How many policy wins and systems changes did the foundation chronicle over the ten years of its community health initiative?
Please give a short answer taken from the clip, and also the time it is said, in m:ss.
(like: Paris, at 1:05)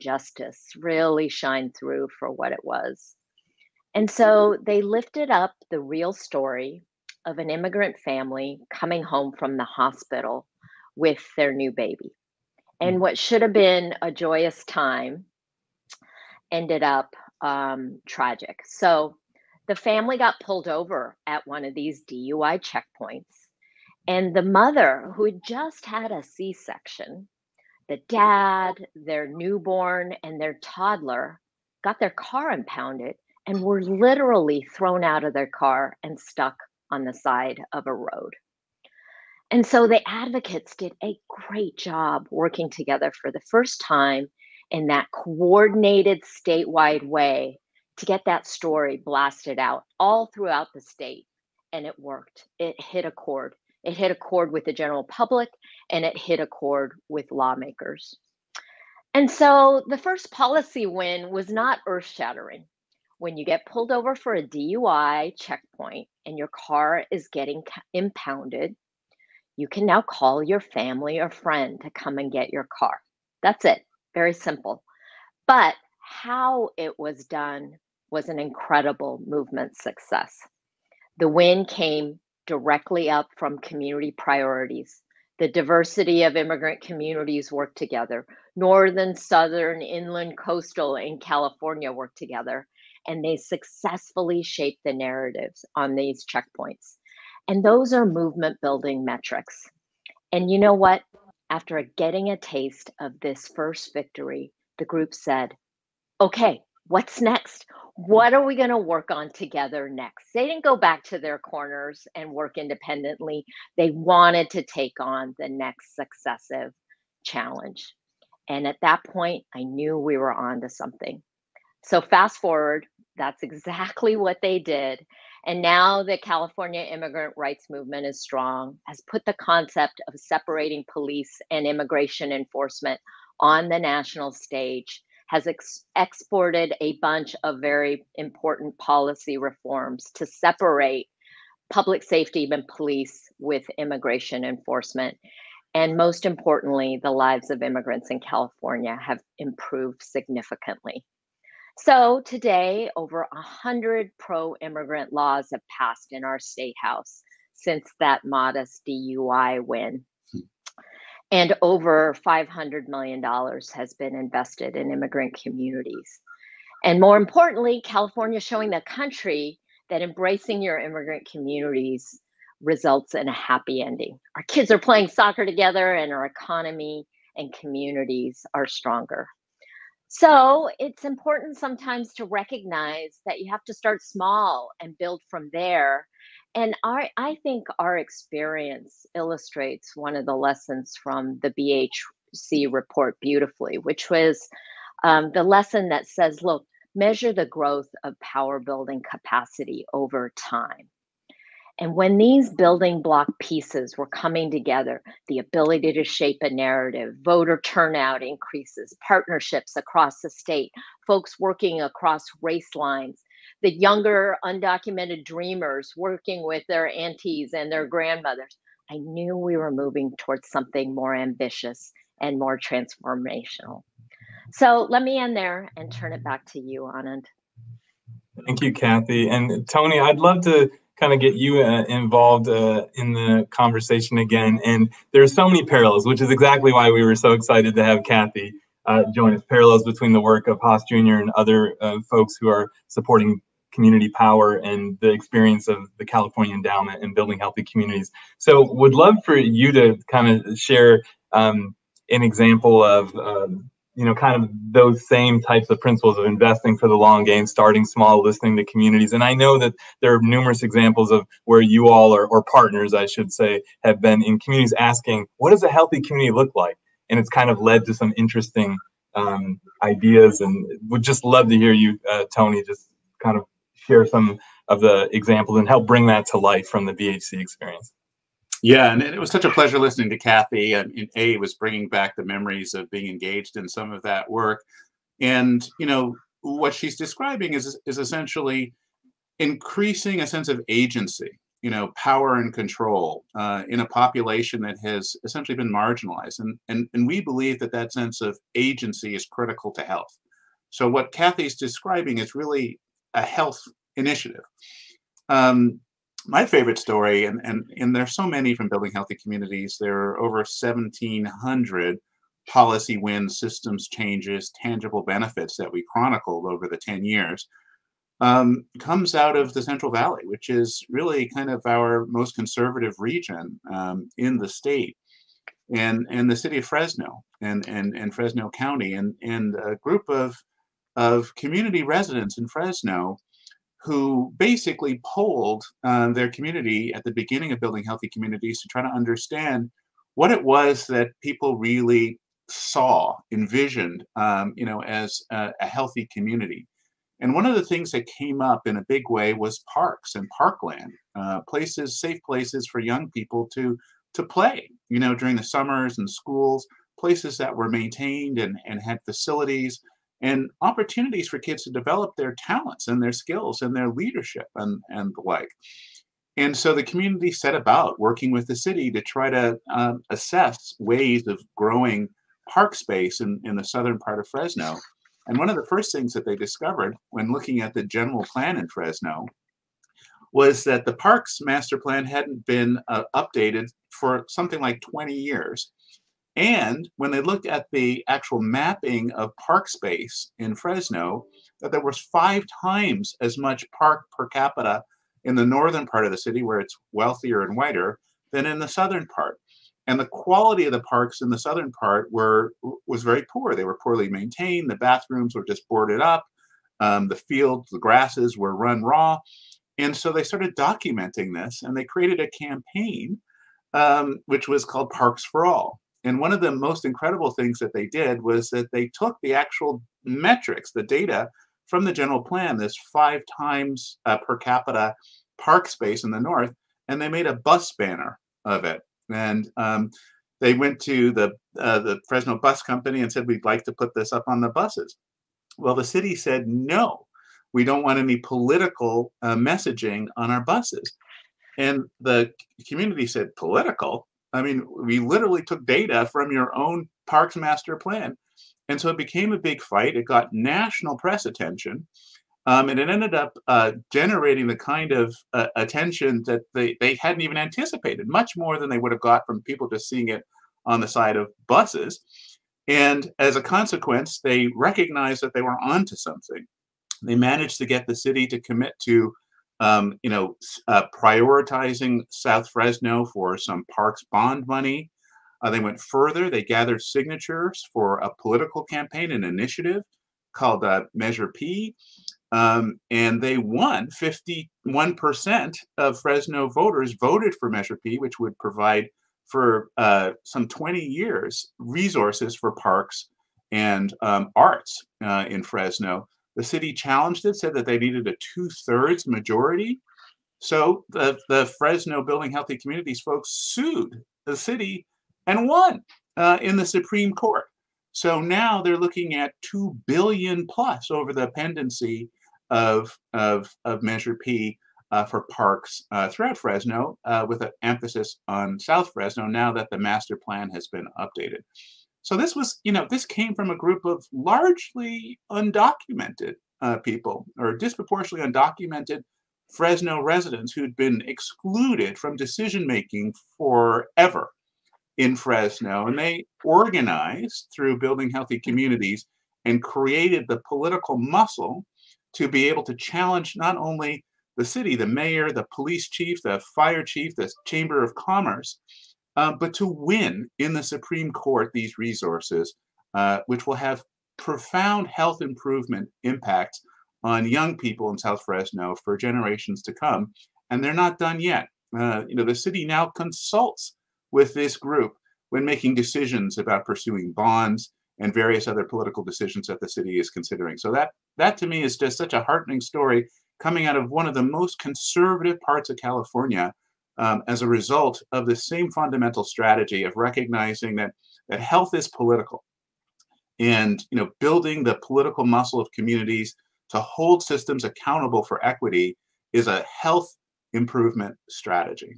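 1,700, at 5:10.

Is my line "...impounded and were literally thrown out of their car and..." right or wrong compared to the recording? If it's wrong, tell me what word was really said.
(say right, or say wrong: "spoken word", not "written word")
right.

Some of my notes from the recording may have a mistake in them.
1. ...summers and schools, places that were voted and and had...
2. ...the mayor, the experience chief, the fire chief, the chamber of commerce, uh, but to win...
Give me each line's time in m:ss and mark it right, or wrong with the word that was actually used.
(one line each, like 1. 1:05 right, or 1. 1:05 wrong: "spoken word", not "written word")
1. 5:55 wrong: "maintained", not "voted"
2. 9:04 wrong: "police", not "experience".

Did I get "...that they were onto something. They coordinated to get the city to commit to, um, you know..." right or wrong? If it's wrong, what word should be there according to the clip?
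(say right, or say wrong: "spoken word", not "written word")
wrong: "managed", not "coordinated".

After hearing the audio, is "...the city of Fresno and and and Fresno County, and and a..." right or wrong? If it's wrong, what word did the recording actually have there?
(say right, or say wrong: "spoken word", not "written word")
right.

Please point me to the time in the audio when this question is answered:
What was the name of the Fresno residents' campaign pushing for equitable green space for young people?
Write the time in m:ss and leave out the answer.
6:54.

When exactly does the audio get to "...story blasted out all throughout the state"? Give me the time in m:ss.
0:48.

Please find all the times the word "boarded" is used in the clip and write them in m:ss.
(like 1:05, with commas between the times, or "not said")
6:45.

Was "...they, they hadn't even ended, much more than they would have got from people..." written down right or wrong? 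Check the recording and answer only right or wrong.
wrong.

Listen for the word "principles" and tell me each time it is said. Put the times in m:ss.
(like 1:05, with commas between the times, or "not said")
4:15.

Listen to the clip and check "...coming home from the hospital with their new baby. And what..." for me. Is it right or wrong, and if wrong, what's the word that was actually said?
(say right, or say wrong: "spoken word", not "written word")
right.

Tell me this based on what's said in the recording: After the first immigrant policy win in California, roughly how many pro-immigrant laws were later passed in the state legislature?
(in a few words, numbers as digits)
over 100.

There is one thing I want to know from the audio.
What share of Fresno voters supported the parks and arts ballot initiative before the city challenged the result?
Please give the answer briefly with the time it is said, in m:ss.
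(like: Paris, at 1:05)
51%, at 8:03.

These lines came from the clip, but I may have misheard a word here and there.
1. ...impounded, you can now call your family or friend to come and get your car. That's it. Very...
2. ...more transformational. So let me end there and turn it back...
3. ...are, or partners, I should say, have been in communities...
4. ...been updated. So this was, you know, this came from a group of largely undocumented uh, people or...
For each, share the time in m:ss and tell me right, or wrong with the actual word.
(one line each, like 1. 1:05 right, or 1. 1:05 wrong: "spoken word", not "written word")
1. 1:07 right
2. 3:42 right
3. 4:22 right
4. 8:40 right.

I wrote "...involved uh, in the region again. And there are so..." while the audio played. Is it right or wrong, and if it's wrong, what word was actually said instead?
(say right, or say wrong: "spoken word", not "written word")
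wrong: "conversation", not "region".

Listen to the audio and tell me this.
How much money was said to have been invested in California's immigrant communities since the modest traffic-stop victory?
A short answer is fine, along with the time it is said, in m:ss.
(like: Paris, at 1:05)
$500 million, at 2:42.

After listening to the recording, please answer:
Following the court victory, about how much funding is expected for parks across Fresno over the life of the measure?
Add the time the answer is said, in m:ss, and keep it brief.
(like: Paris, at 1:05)
2 billion plus, at 8:29.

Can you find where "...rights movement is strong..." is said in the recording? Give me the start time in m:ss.
2:07.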